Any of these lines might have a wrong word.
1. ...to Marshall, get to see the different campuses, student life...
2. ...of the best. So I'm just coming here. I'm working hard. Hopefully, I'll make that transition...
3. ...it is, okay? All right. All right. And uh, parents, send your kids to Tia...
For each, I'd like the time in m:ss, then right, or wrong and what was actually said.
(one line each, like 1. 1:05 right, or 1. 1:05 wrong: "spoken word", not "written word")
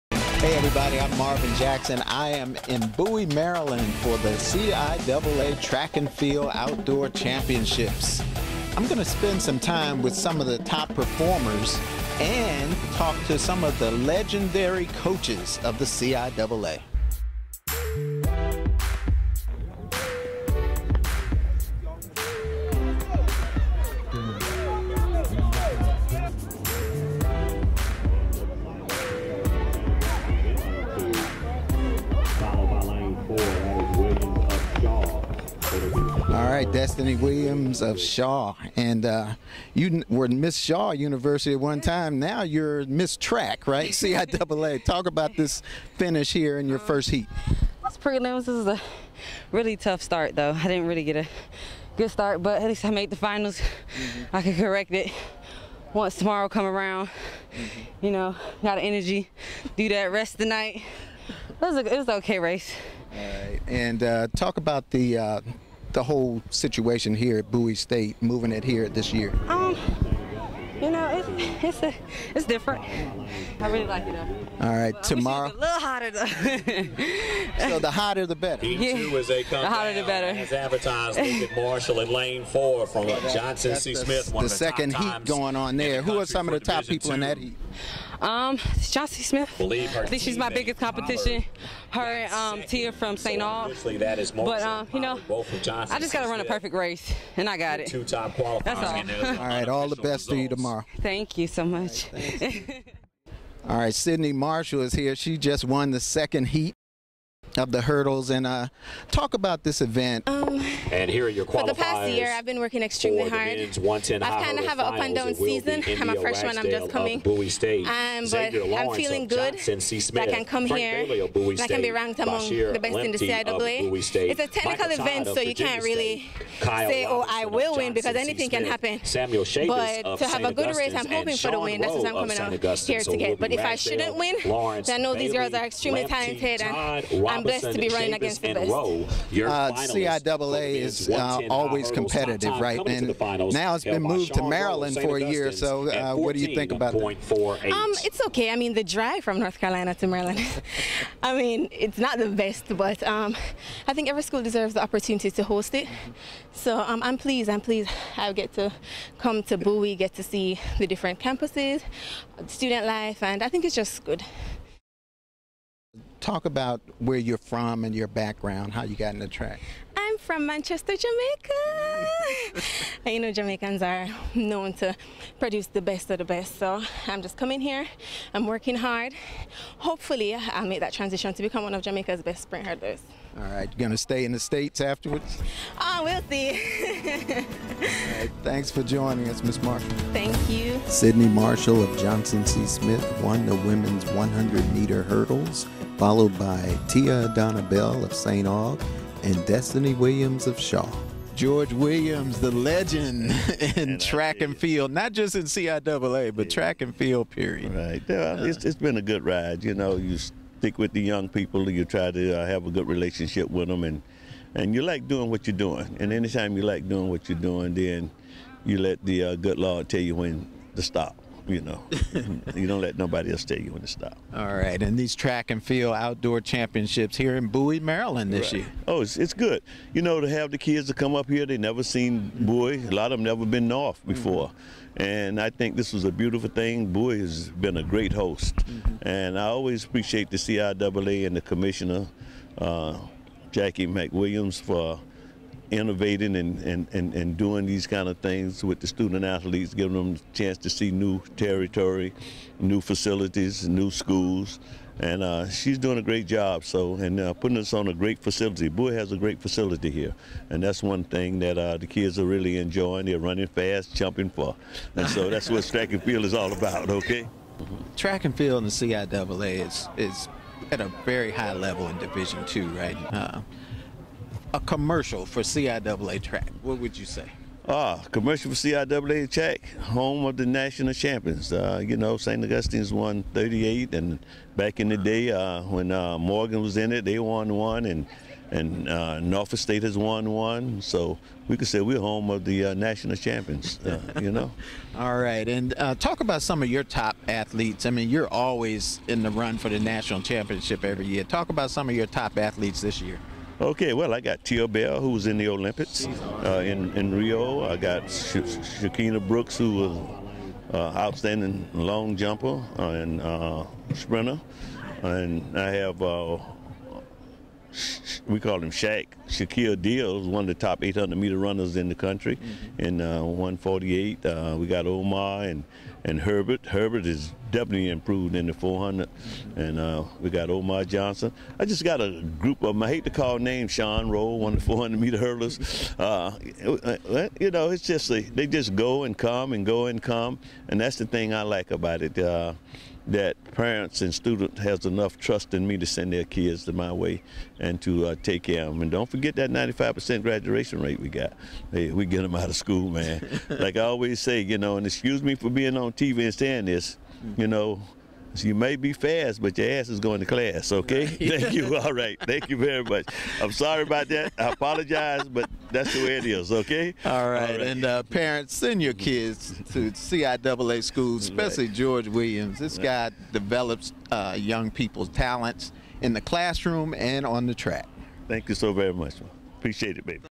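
1. 2:39 wrong: "Bowie", not "Marshall"
2. 2:56 right
3. 6:06 wrong: "CIAA", not "Tia".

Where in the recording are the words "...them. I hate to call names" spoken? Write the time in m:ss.
5:32.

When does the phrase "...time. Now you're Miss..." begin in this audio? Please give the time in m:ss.
0:41.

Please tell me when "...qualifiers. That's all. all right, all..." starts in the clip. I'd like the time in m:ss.
1:38.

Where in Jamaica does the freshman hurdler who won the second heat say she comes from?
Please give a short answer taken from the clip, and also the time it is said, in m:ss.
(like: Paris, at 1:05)
Manchester, at 2:50.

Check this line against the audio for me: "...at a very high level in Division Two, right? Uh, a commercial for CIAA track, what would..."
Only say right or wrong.
right.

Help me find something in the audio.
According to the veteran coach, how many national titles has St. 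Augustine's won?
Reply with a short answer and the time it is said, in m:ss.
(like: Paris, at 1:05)
38, at 4:42.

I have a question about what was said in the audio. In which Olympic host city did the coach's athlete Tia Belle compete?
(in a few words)
Rio.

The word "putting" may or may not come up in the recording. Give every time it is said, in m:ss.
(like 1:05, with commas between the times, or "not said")
4:17.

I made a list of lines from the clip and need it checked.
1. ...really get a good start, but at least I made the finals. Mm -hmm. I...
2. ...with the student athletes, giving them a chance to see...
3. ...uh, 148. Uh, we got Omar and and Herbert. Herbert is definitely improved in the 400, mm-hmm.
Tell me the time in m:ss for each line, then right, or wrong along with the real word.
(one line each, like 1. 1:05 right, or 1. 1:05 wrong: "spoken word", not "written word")
1. 0:50 right
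2. 4:08 right
3. 5:23 right.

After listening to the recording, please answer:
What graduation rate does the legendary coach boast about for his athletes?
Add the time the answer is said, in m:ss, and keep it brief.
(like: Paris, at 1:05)
95%, at 5:49.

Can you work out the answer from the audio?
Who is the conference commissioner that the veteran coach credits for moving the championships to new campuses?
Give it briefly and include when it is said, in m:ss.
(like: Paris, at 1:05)
Jackie McWilliams, at 4:03.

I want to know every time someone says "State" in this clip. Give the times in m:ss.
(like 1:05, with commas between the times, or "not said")
1:07, 1:57, 2:01, 3:04, 4:49.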